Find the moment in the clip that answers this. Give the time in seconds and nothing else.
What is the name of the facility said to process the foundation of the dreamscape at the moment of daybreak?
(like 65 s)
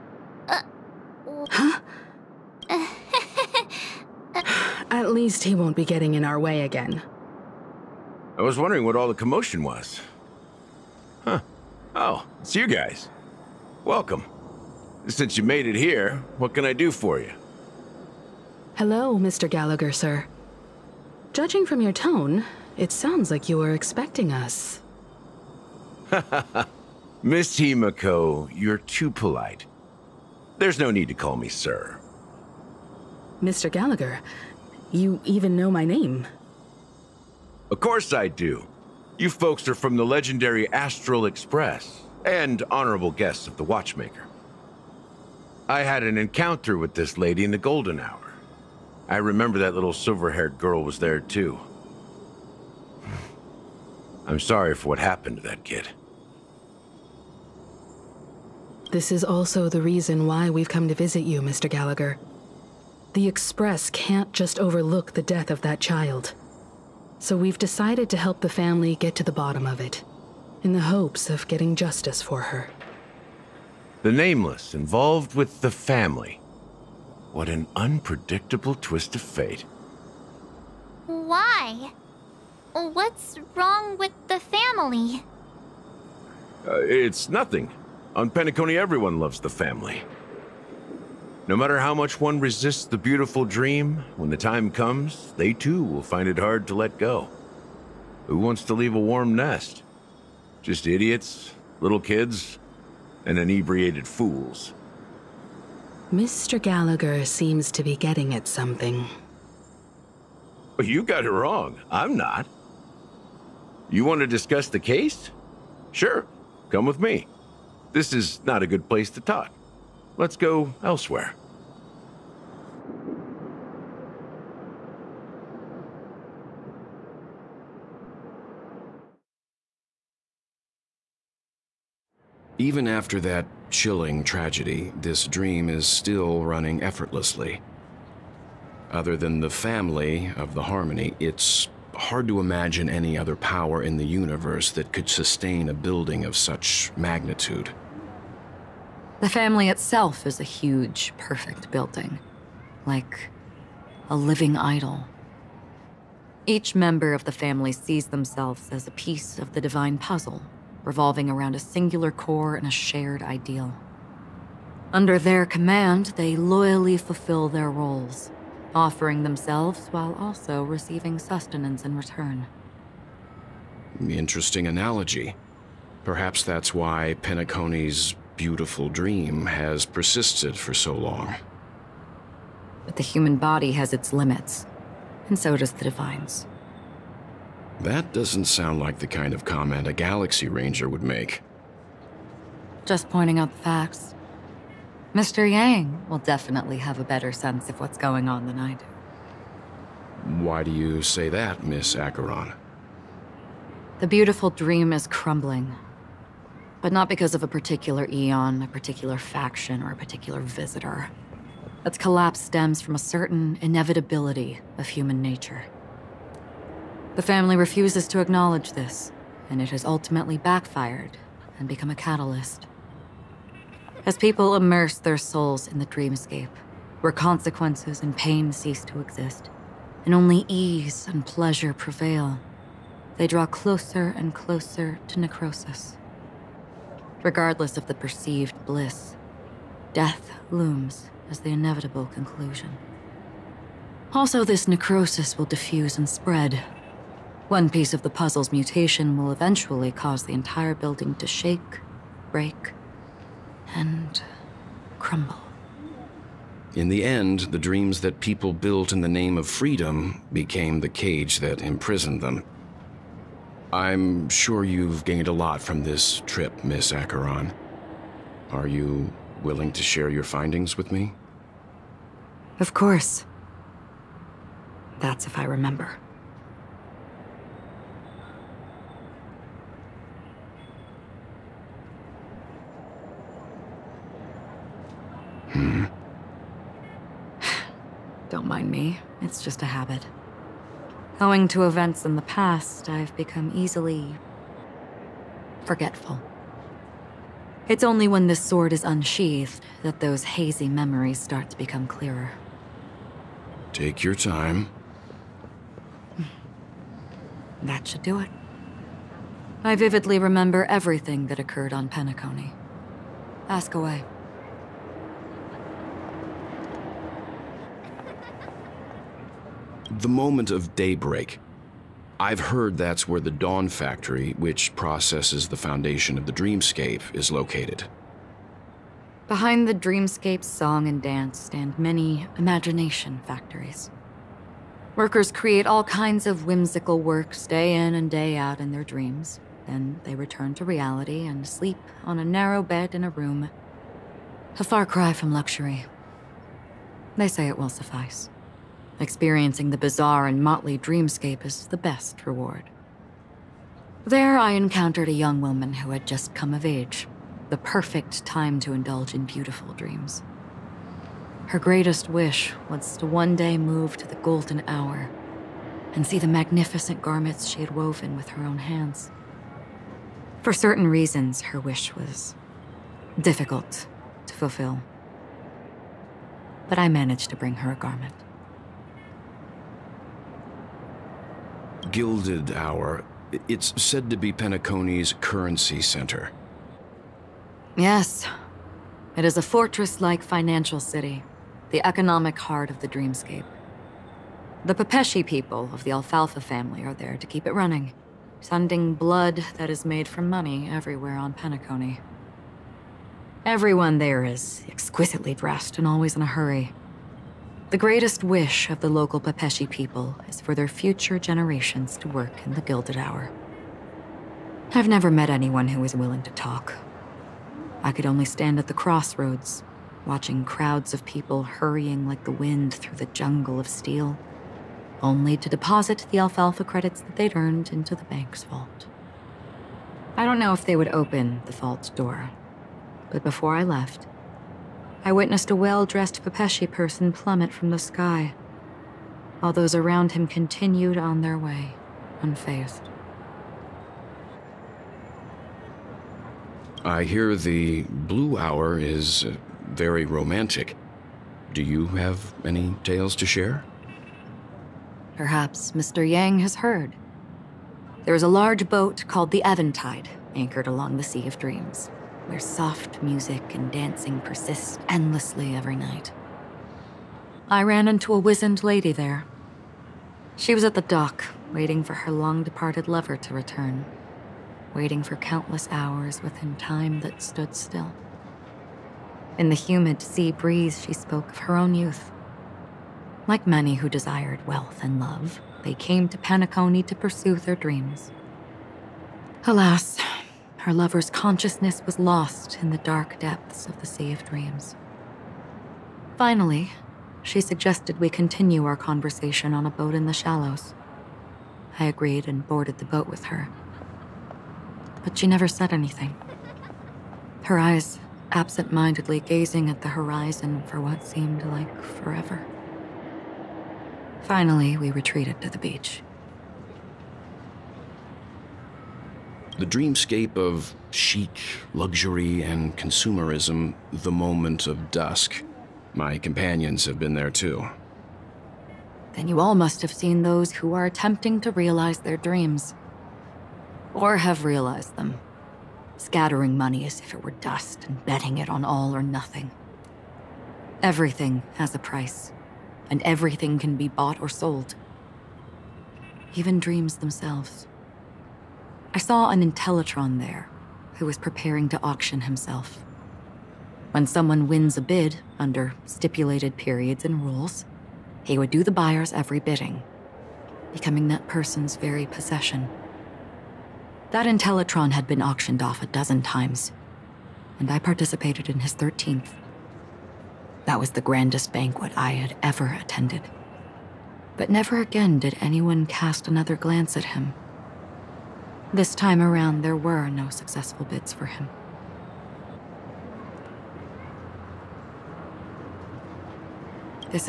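323 s.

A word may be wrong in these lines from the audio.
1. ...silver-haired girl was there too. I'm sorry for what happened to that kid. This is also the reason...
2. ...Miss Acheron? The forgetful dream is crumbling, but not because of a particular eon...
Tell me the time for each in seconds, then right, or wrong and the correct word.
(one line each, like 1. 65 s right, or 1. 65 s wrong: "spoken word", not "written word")
1. 49 s right
2. 201 s wrong: "beautiful", not "forgetful".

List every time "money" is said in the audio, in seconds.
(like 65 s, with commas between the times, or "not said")
400 s, 536 s.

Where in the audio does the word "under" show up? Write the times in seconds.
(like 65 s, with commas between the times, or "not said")
164 s, 555 s.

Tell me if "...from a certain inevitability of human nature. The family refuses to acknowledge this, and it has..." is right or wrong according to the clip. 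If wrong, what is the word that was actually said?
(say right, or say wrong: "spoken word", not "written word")
right.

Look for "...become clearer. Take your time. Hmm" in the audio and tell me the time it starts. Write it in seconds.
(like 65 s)
301 s.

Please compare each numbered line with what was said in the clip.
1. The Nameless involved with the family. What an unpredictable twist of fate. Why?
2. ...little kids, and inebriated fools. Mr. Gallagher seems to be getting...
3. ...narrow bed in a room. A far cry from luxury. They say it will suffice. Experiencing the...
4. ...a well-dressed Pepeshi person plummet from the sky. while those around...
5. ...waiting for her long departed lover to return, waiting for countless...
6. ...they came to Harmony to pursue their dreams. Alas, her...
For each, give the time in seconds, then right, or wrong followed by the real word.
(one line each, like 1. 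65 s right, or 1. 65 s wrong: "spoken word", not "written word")
1. 74 s right
2. 101 s right
3. 342 s right
4. 435 s right
5. 471 s right
6. 485 s wrong: "Penacony", not "Harmony".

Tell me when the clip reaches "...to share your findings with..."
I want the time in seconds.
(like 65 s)
269 s.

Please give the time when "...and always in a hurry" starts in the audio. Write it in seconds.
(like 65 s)
405 s.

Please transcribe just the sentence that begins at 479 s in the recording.
In the humid sea breeze, she spoke of her own youth.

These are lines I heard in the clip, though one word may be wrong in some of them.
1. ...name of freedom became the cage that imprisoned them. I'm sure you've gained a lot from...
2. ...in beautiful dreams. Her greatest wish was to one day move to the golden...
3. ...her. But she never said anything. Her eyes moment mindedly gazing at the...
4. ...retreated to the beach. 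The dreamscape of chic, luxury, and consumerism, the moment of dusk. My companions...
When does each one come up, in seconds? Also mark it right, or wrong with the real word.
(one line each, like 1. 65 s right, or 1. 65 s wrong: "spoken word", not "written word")
1. 259 s right
2. 359 s right
3. 503 s wrong: "absent", not "moment"
4. 514 s right.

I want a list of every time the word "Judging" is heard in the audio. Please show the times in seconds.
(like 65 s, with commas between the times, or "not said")
21 s.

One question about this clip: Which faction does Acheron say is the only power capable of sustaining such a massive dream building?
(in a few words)
the Harmony.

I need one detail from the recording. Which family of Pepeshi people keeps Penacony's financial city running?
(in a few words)
Alfalfa family.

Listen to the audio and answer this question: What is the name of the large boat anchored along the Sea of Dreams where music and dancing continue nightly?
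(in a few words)
the Eventide.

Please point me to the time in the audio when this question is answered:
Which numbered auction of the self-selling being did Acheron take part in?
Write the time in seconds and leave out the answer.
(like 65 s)
568 s.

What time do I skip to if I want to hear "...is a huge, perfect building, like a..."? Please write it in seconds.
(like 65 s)
150 s.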